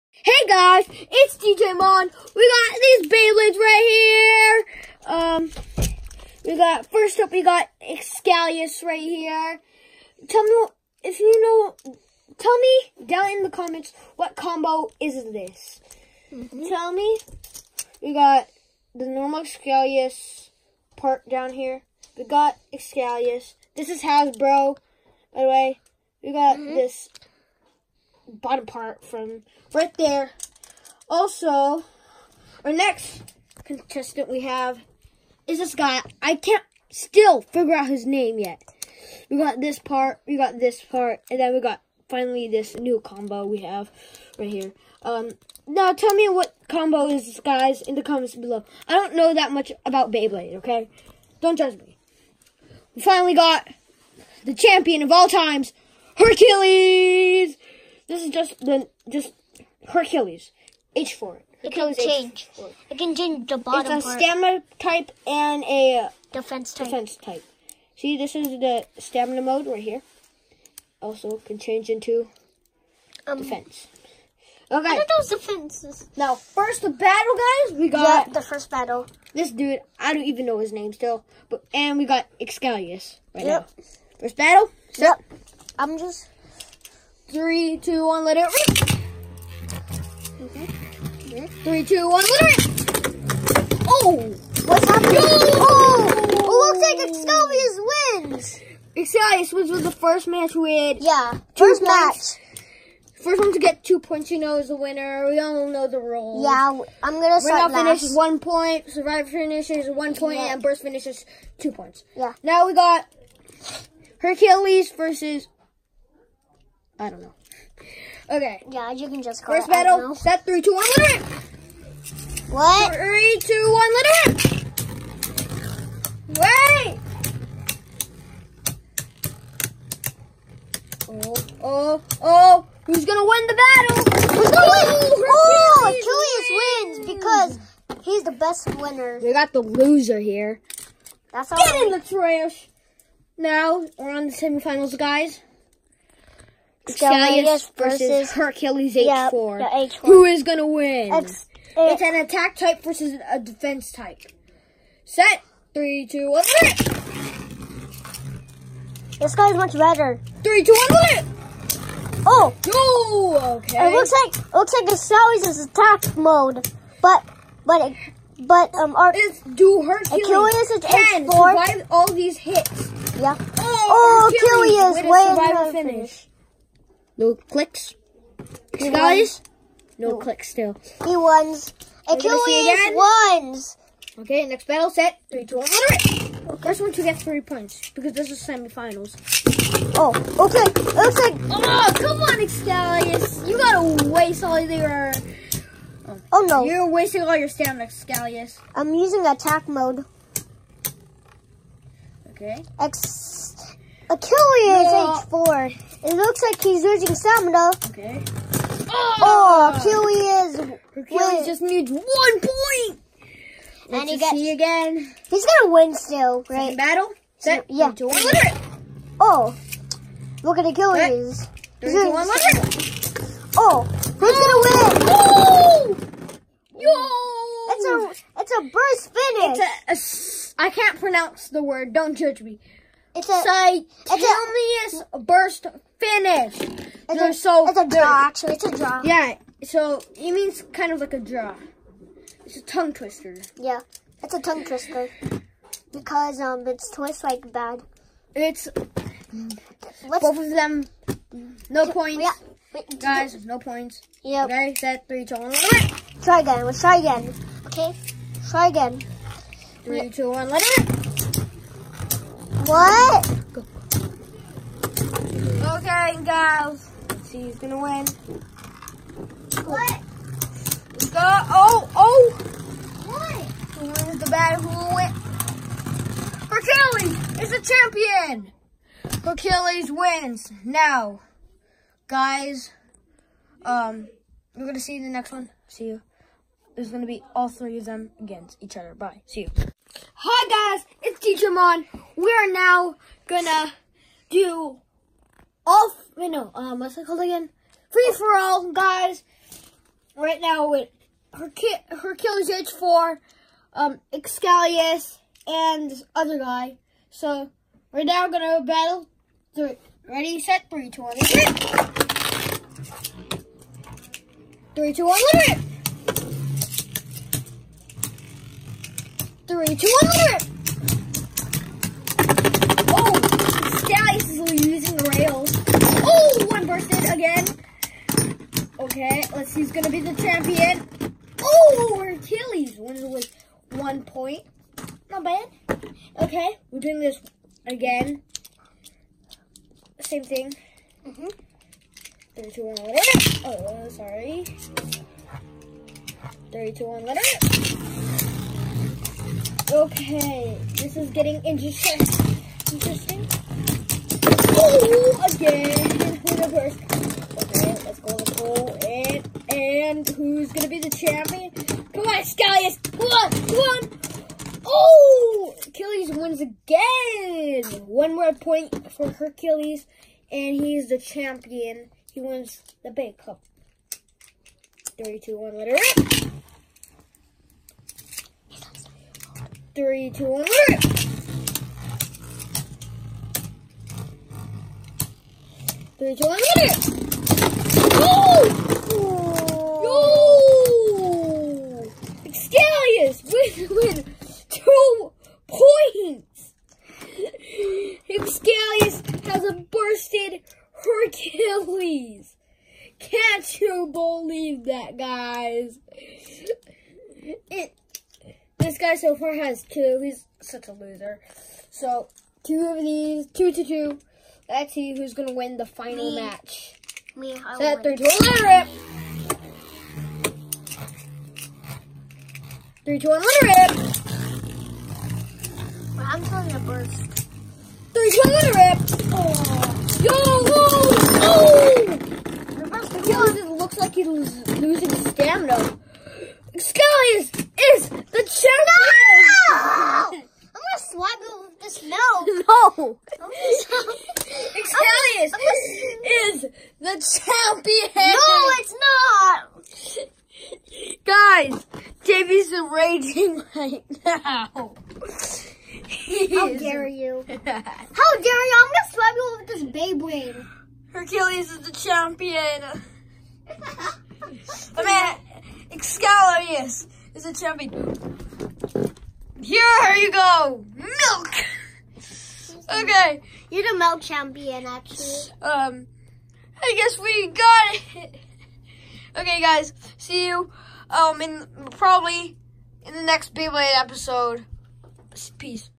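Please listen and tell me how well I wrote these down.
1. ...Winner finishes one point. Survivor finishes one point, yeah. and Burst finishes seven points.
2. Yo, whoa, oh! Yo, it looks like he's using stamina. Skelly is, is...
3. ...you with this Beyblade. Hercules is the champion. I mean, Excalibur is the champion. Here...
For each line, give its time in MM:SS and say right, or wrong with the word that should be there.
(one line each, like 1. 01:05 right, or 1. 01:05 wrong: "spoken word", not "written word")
1. 01:47 wrong: "two", not "seven"
2. 07:10 wrong: "losing", not "using"
3. 07:39 right.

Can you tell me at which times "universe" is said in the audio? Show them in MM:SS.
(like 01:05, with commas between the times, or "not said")
05:56.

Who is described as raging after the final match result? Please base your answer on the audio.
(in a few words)
Davey.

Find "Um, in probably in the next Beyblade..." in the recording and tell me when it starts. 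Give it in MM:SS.
08:00.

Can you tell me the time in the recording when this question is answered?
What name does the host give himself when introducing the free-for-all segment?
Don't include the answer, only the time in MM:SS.
04:51.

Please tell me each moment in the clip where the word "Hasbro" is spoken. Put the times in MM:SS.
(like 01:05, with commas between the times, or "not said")
00:24.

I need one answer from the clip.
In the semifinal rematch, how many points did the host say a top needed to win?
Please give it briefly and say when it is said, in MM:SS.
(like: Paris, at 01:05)
3, at 03:07.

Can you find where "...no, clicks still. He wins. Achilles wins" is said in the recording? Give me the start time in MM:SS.
03:00.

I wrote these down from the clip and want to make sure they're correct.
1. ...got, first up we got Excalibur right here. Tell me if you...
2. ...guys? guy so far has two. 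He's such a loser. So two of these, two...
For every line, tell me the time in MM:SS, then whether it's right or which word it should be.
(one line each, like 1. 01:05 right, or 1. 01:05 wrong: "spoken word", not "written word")
1. 00:06 wrong: "Xcalius", not "Excalibur"
2. 06:44 right.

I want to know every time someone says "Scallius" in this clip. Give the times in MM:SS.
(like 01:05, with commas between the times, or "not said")
06:02.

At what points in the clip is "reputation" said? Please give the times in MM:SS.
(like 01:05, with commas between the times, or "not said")
not said.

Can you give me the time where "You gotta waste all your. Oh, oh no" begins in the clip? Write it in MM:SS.
03:13.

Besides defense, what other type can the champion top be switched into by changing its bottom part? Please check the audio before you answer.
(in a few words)
stamina type.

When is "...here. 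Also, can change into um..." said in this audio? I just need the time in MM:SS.
01:09.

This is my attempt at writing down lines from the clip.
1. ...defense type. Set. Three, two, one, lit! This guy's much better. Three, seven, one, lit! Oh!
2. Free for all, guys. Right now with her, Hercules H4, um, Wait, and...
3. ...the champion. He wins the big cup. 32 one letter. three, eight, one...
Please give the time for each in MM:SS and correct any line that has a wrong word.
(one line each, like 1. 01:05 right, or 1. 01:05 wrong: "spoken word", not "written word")
1. 02:33 wrong: "two", not "seven"
2. 04:57 wrong: "Excalius", not "Wait"
3. 06:10 wrong: "two", not "eight".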